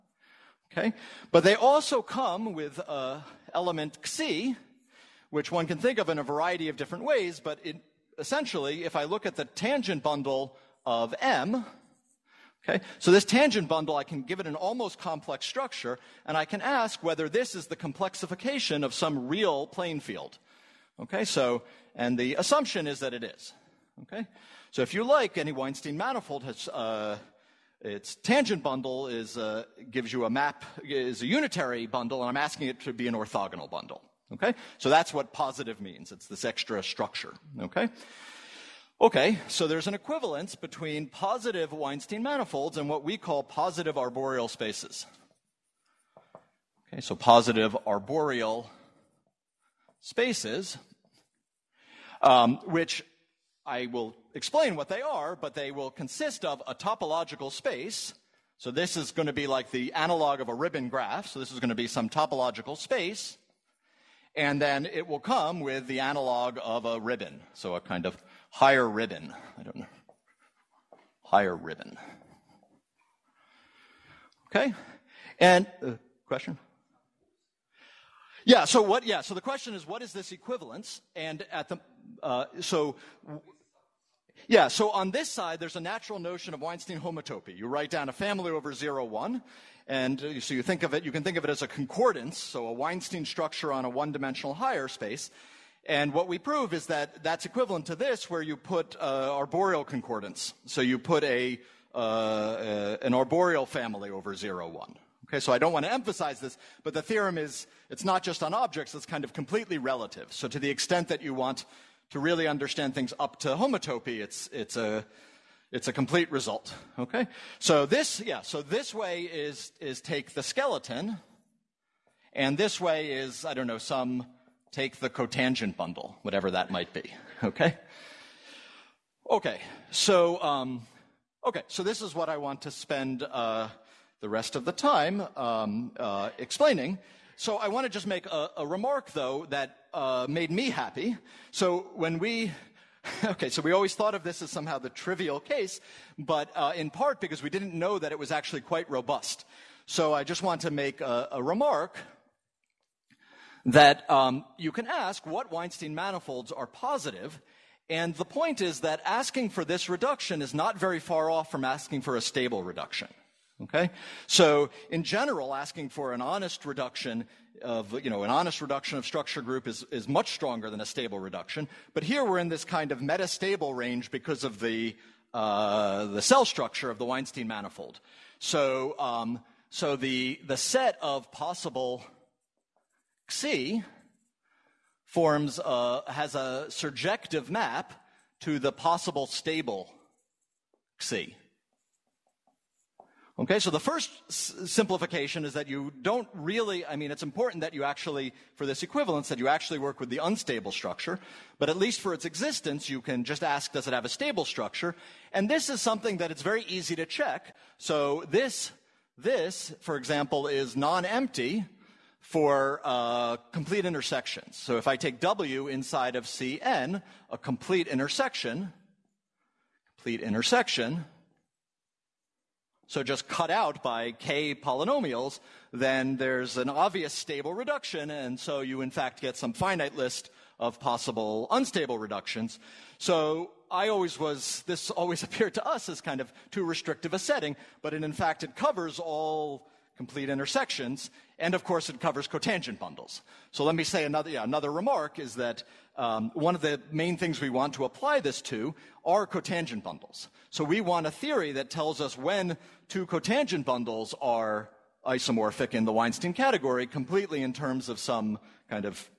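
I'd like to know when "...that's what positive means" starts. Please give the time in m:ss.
0:34.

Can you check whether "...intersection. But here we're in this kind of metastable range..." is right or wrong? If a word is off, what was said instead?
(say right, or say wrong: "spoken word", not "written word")
wrong: "reduction", not "intersection".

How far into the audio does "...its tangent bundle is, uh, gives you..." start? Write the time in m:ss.
0:27.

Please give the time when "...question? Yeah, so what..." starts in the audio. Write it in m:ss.
1:16.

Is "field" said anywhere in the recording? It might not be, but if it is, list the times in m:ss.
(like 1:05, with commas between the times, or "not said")
0:19.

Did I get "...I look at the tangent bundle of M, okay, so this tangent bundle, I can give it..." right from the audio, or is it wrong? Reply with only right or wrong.
right.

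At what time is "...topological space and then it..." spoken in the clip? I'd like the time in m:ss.
1:02.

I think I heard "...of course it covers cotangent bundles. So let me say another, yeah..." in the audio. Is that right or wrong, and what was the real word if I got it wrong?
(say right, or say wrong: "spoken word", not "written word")
right.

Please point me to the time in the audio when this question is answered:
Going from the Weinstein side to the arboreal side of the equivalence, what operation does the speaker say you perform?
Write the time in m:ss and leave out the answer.
2:00.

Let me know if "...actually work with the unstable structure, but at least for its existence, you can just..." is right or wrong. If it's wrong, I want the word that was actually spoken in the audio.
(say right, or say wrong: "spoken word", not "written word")
right.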